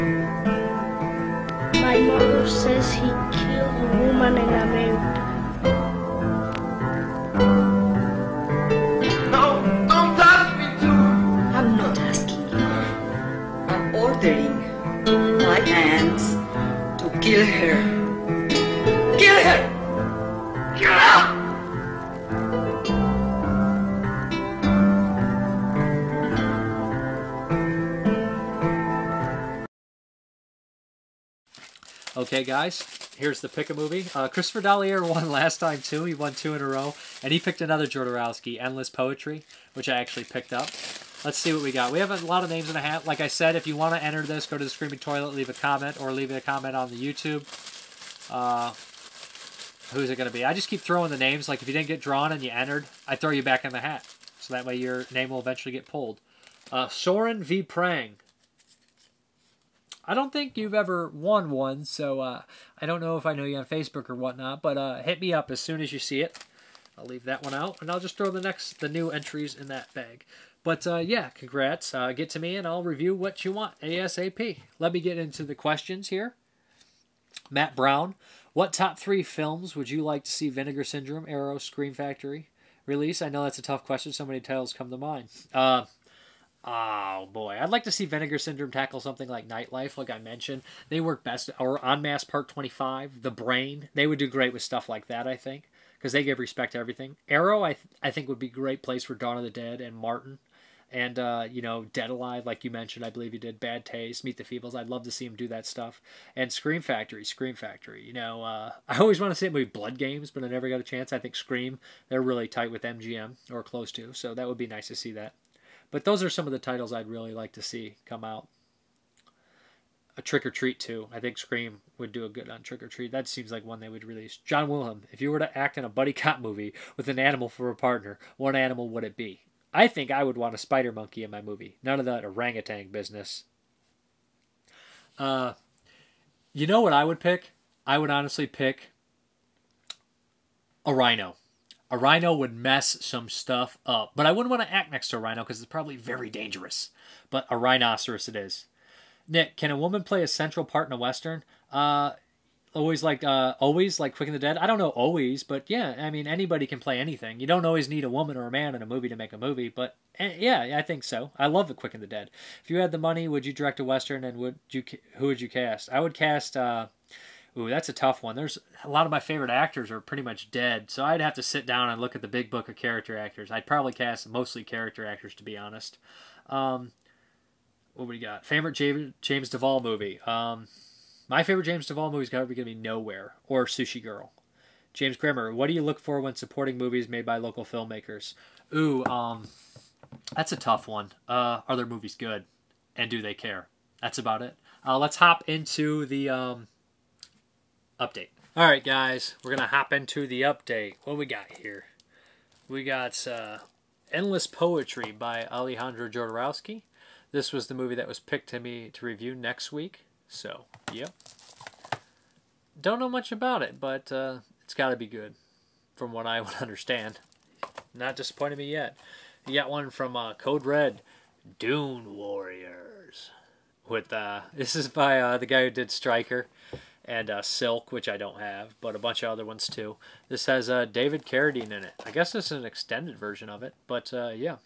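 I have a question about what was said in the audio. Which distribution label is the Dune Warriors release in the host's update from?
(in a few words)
Code Red.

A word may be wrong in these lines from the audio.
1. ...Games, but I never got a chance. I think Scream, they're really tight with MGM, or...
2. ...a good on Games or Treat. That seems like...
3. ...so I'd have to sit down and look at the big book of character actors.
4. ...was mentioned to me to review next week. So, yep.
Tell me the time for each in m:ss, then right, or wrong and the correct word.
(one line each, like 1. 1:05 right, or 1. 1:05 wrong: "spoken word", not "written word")
1. 1:49 right
2. 2:02 wrong: "Trick", not "Games"
3. 2:50 right
4. 3:28 wrong: "picked", not "mentioned".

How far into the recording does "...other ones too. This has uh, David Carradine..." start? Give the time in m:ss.
3:49.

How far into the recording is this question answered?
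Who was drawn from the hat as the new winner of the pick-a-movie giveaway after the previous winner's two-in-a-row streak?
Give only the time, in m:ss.
0:56.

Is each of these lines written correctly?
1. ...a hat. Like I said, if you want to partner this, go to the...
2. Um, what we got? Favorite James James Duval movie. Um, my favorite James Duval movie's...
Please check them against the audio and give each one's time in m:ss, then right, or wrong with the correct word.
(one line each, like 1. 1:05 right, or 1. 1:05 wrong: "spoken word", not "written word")
1. 0:42 wrong: "enter", not "partner"
2. 2:56 right.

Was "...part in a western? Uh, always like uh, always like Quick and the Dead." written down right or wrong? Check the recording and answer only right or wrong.
right.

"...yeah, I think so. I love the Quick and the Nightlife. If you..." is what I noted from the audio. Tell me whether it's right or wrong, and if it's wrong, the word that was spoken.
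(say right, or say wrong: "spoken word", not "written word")
wrong: "Dead", not "Nightlife".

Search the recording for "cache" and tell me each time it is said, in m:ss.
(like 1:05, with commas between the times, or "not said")
not said.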